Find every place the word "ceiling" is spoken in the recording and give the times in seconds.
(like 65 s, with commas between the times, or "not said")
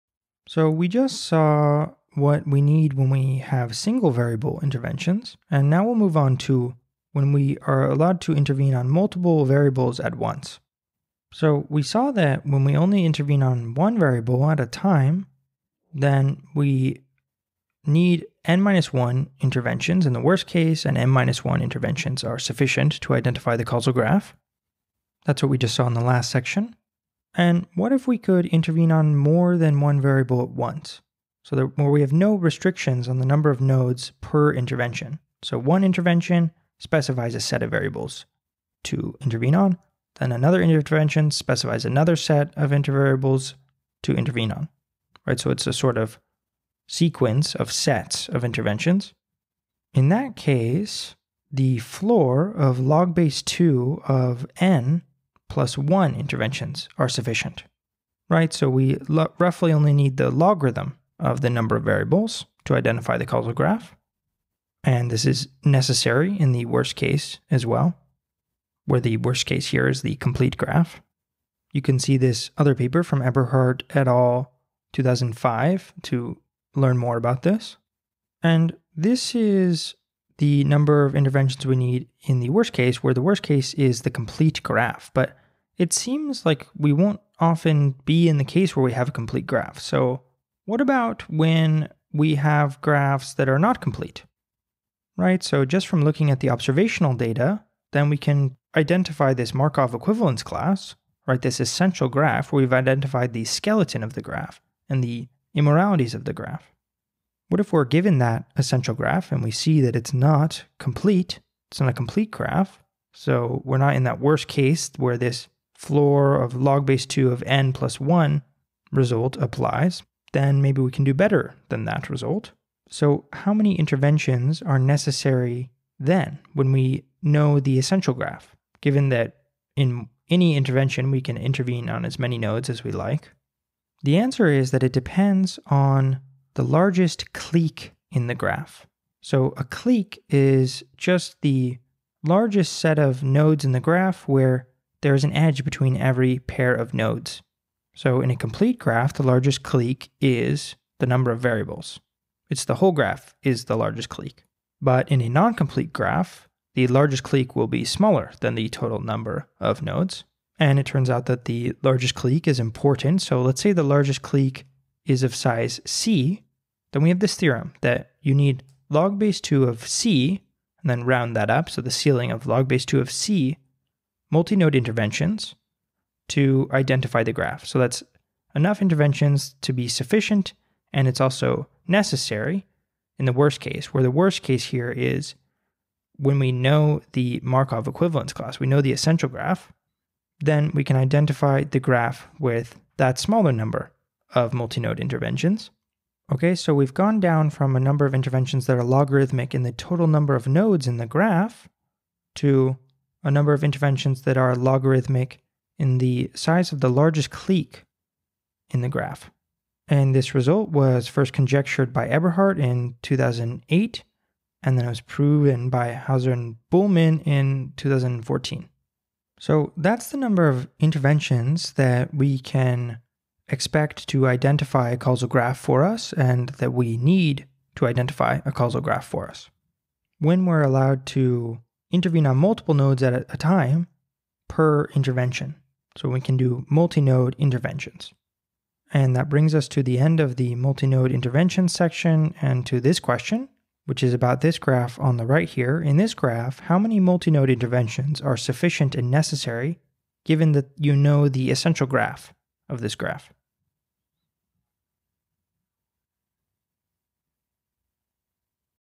171 s.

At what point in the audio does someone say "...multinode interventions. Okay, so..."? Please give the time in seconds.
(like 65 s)
194 s.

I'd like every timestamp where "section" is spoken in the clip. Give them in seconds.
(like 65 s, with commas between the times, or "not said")
26 s, 241 s.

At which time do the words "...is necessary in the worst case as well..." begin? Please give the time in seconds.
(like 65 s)
65 s.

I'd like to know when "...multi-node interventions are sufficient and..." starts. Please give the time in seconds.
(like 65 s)
246 s.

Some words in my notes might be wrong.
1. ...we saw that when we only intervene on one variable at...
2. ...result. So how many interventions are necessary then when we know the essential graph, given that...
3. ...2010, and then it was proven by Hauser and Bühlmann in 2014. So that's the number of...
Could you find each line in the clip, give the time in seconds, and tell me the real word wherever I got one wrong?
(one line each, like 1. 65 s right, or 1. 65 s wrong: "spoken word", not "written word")
1. 11 s right
2. 122 s right
3. 213 s wrong: "2008", not "2010".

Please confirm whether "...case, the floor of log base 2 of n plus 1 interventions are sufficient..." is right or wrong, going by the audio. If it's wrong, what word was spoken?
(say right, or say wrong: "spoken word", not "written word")
right.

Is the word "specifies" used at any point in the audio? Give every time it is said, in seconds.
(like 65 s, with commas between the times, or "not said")
36 s, 41 s.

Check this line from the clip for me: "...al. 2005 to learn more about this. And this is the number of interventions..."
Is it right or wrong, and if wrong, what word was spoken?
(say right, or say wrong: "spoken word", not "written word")
right.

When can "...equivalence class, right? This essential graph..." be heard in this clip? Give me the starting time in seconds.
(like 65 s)
99 s.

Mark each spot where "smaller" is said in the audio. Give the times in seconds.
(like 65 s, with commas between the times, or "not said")
157 s, 193 s.